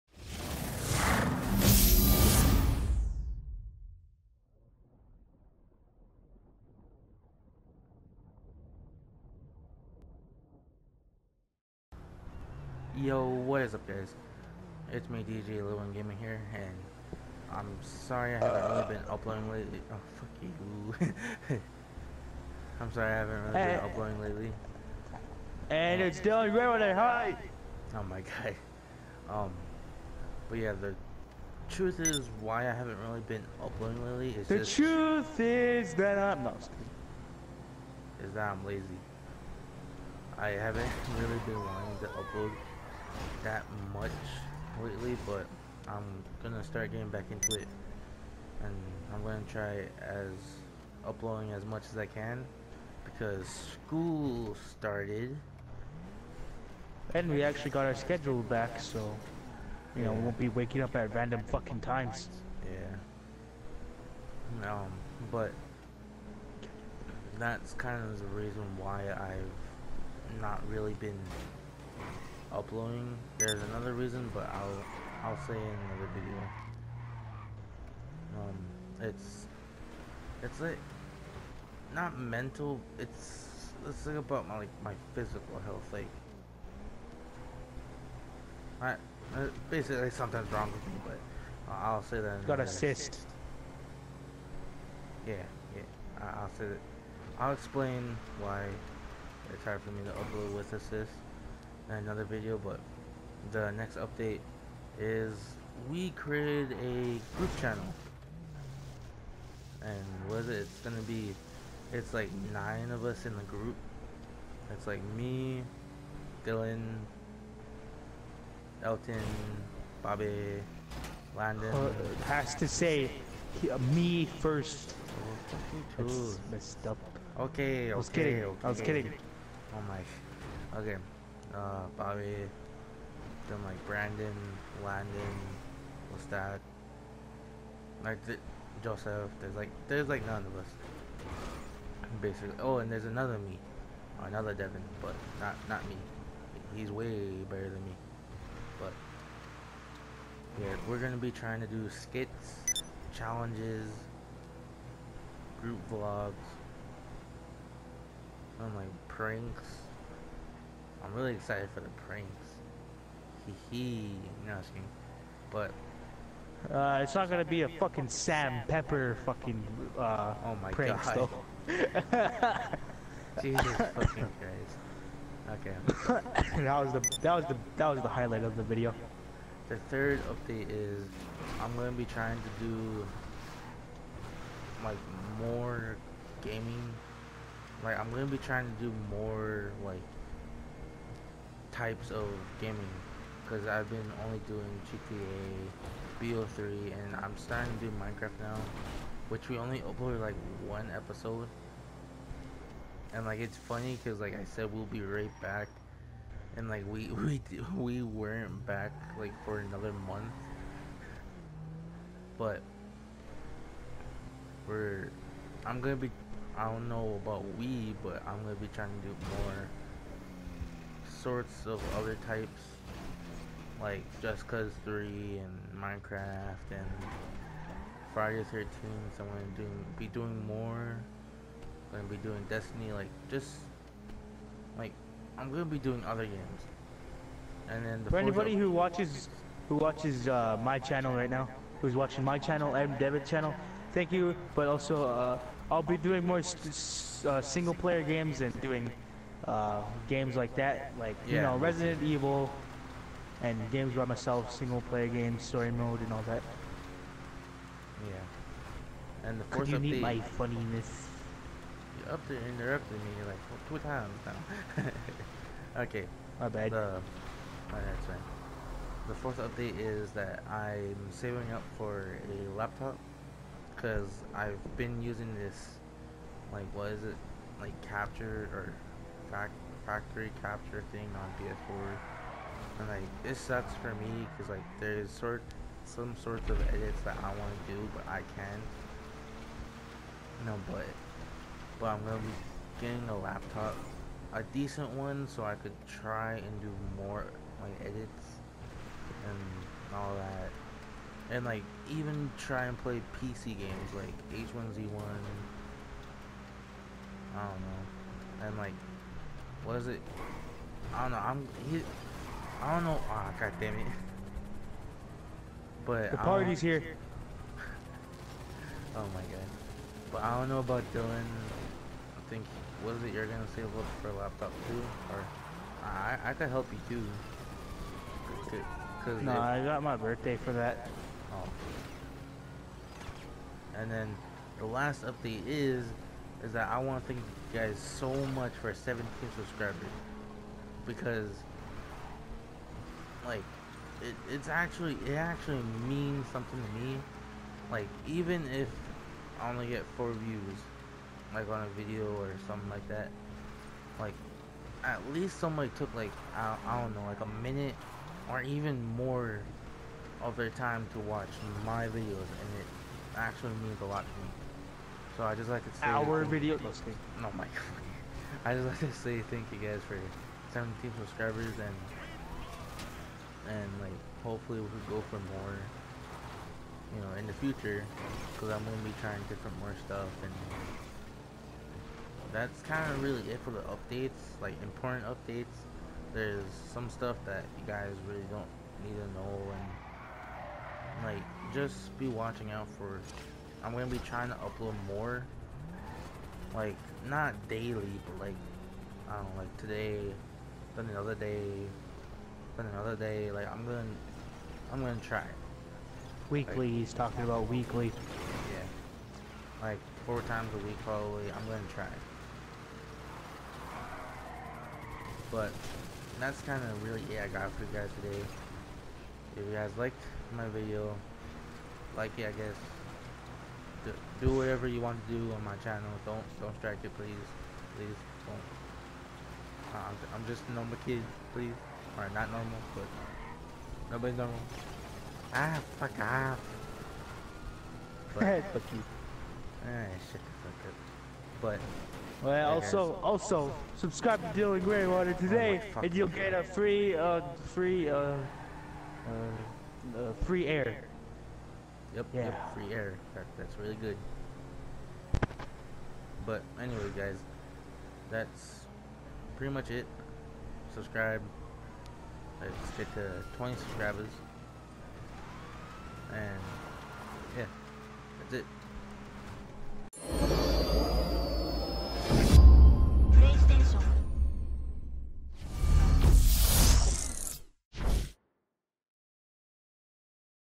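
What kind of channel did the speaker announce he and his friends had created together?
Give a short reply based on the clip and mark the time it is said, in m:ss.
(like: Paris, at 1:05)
Group channel, at 1:47.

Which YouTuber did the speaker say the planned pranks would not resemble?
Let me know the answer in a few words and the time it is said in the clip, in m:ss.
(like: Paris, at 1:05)
Sam Pepper, at 2:48.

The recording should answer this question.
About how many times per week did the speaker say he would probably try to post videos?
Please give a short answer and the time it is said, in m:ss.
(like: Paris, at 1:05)
4, at 6:50.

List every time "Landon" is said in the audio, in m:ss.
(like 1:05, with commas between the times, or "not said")
2:01, 2:14.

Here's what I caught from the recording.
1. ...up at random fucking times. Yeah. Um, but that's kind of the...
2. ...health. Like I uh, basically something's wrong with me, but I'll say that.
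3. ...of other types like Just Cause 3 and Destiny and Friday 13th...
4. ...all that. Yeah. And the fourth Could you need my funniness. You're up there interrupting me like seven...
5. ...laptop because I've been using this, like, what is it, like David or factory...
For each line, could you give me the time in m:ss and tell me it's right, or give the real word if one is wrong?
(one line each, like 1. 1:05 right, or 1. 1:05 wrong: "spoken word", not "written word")
1. 1:00 right
2. 1:25 right
3. 3:41 wrong: "Minecraft", not "Destiny"
4. 4:16 wrong: "two", not "seven"
5. 4:32 wrong: "Capture", not "David".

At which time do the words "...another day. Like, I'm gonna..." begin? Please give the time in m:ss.
6:42.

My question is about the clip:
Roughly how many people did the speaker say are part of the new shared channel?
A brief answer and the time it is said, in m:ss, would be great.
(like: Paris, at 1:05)
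9, at 1:52.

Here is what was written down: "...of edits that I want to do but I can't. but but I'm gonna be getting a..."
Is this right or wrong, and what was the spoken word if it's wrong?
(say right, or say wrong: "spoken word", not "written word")
right.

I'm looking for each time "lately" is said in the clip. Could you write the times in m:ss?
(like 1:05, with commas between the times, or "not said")
0:19, 0:24, 0:34, 0:44.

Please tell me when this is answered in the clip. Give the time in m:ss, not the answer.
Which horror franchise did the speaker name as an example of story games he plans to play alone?
4:11.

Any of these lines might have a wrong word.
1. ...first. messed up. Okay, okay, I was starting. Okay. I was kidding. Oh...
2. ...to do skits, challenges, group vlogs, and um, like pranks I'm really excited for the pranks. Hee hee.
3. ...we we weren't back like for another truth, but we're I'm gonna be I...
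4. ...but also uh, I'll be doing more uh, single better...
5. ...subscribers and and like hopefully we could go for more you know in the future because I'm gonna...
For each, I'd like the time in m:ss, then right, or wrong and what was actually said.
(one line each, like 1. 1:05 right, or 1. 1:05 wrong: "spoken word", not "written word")
1. 2:04 wrong: "kidding", not "starting"
2. 2:31 right
3. 3:27 wrong: "month", not "truth"
4. 4:04 wrong: "player", not "better"
5. 6:10 right.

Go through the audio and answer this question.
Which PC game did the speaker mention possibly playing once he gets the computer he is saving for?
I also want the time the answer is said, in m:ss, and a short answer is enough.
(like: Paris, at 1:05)
H1Z1, at 5:04.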